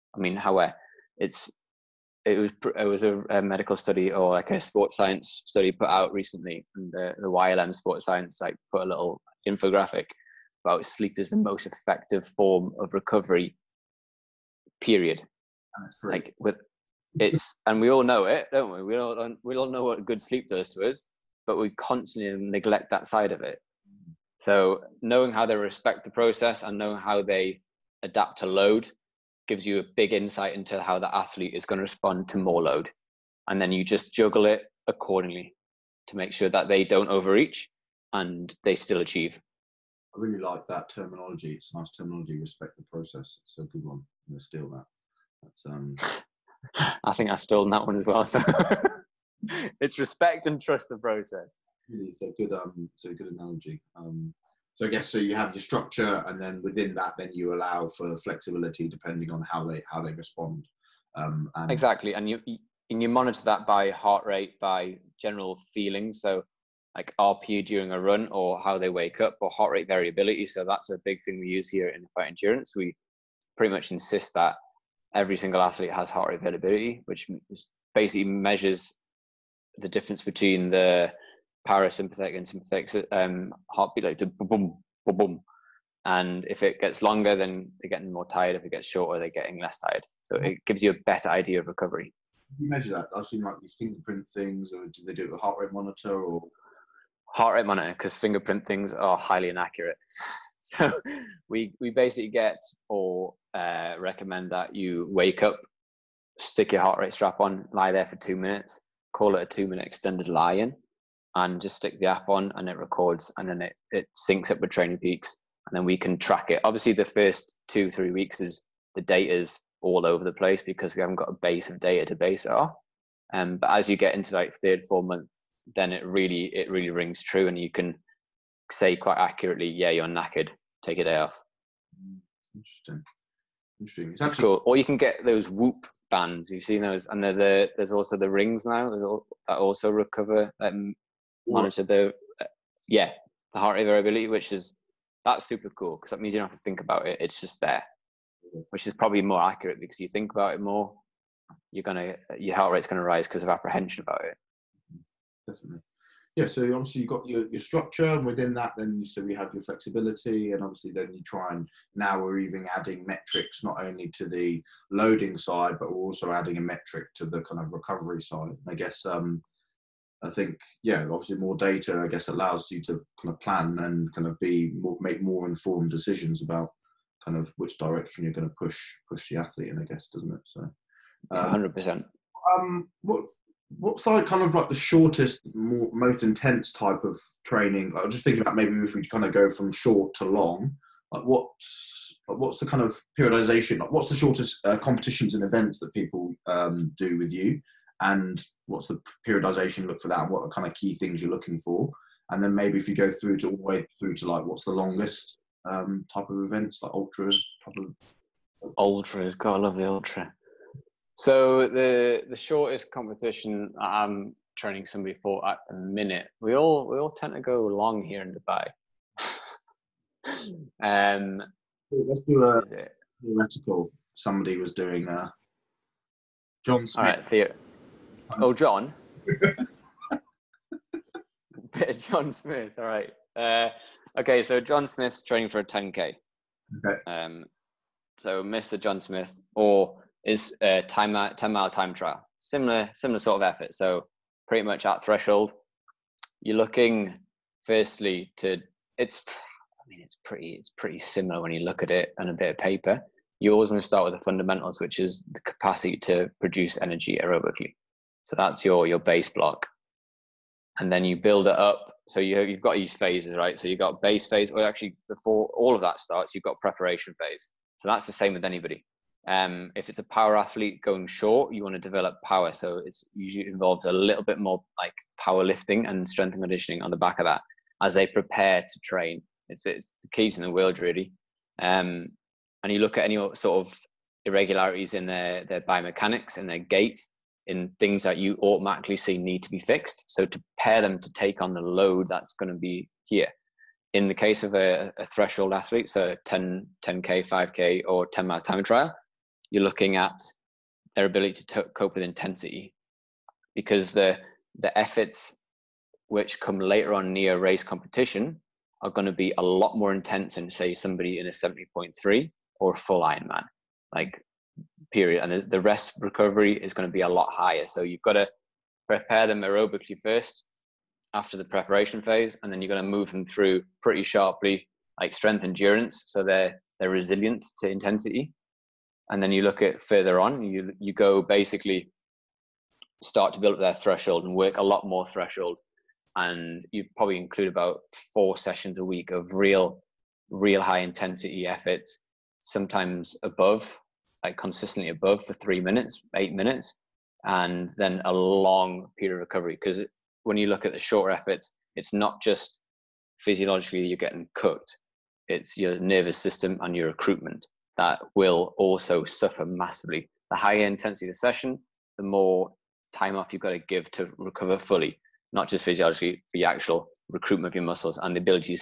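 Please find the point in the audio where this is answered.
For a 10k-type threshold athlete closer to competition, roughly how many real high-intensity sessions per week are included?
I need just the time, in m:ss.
5:38.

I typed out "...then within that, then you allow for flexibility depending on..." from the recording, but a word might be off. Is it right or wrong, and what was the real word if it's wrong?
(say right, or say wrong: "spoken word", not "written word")
right.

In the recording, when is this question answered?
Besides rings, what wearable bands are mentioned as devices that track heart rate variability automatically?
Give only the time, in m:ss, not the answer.
2:15.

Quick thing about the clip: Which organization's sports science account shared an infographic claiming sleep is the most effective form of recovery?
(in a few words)
YLM Sports Science.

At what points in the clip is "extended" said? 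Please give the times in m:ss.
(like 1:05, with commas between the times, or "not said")
1:49.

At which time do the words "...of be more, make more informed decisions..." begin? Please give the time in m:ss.
2:54.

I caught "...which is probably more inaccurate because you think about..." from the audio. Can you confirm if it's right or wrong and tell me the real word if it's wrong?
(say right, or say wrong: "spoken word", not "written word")
wrong: "accurate", not "inaccurate".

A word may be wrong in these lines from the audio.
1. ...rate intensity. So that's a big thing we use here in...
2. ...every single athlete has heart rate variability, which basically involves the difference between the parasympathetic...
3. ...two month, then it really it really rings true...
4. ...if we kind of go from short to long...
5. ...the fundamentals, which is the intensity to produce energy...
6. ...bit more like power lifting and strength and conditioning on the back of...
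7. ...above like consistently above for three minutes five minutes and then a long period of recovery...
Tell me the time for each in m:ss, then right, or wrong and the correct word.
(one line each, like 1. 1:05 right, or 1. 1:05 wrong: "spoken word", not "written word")
1. 1:09 wrong: "variability", not "intensity"
2. 1:15 wrong: "measures", not "involves"
3. 2:04 wrong: "four", not "two"
4. 3:08 right
5. 4:14 wrong: "capacity", not "intensity"
6. 4:34 right
7. 5:43 wrong: "eight", not "five".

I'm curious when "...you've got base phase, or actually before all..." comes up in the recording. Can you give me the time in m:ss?
4:23.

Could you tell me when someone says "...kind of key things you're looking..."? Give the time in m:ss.
3:20.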